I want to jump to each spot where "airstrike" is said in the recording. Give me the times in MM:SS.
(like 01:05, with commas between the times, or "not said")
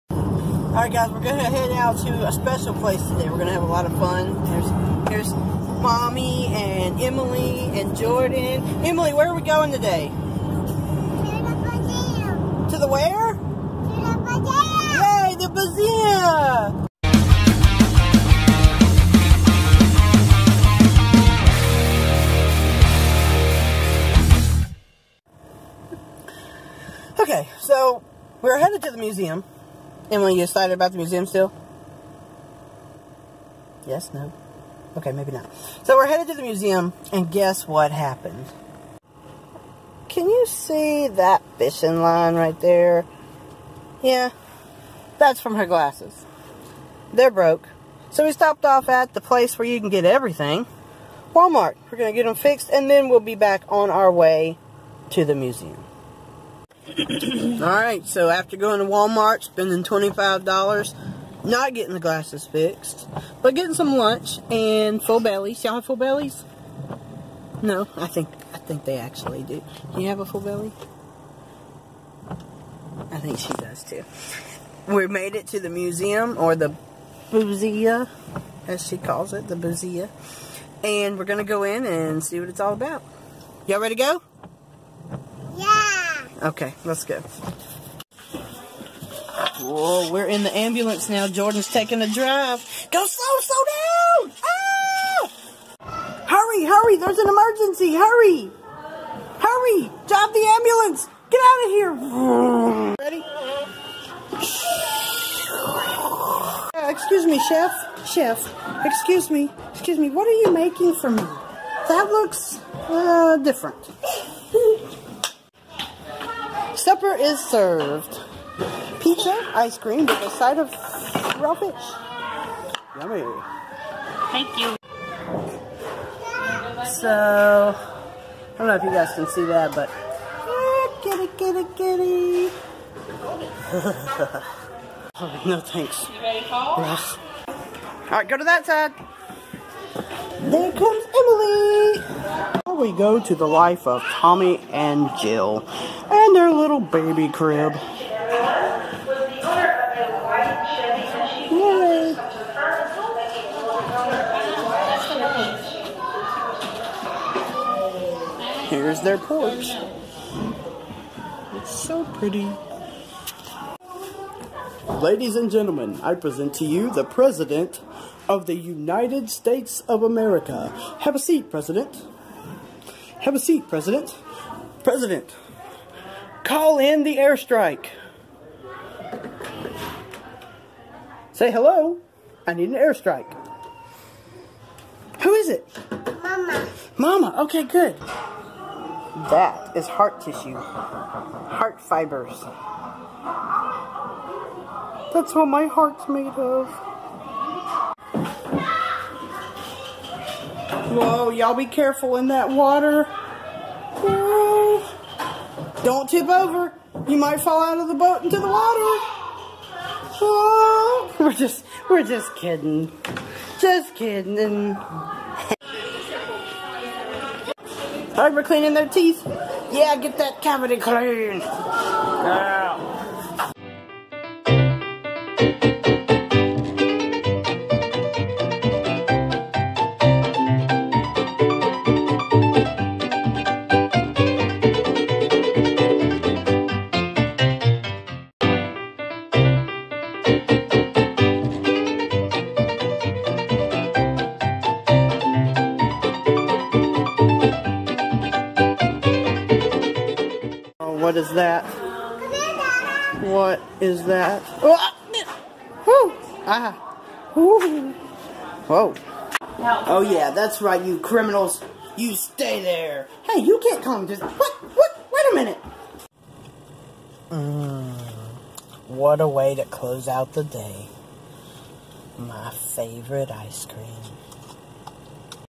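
02:57, 03:02.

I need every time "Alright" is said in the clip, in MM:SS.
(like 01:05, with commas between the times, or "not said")
00:00, 00:56.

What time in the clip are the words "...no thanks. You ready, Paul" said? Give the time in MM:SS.
02:15.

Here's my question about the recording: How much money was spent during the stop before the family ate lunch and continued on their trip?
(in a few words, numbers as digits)
$25.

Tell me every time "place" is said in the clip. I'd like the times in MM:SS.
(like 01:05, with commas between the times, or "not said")
00:02, 00:49.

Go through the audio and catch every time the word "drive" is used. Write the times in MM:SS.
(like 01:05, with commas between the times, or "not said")
01:32, 01:40.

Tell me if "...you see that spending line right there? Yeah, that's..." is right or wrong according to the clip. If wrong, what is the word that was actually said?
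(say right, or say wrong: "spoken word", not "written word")
wrong: "fishing", not "spending".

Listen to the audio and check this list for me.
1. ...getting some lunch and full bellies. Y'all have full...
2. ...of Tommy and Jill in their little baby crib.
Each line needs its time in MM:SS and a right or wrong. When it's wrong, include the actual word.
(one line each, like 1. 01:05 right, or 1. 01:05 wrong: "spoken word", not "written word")
1. 01:03 right
2. 02:23 right.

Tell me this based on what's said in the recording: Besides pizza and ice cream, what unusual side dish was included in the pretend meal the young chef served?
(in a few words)
raw fish.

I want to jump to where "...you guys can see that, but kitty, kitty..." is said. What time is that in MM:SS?
02:08.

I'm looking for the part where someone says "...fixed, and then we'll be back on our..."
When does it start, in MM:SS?
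00:52.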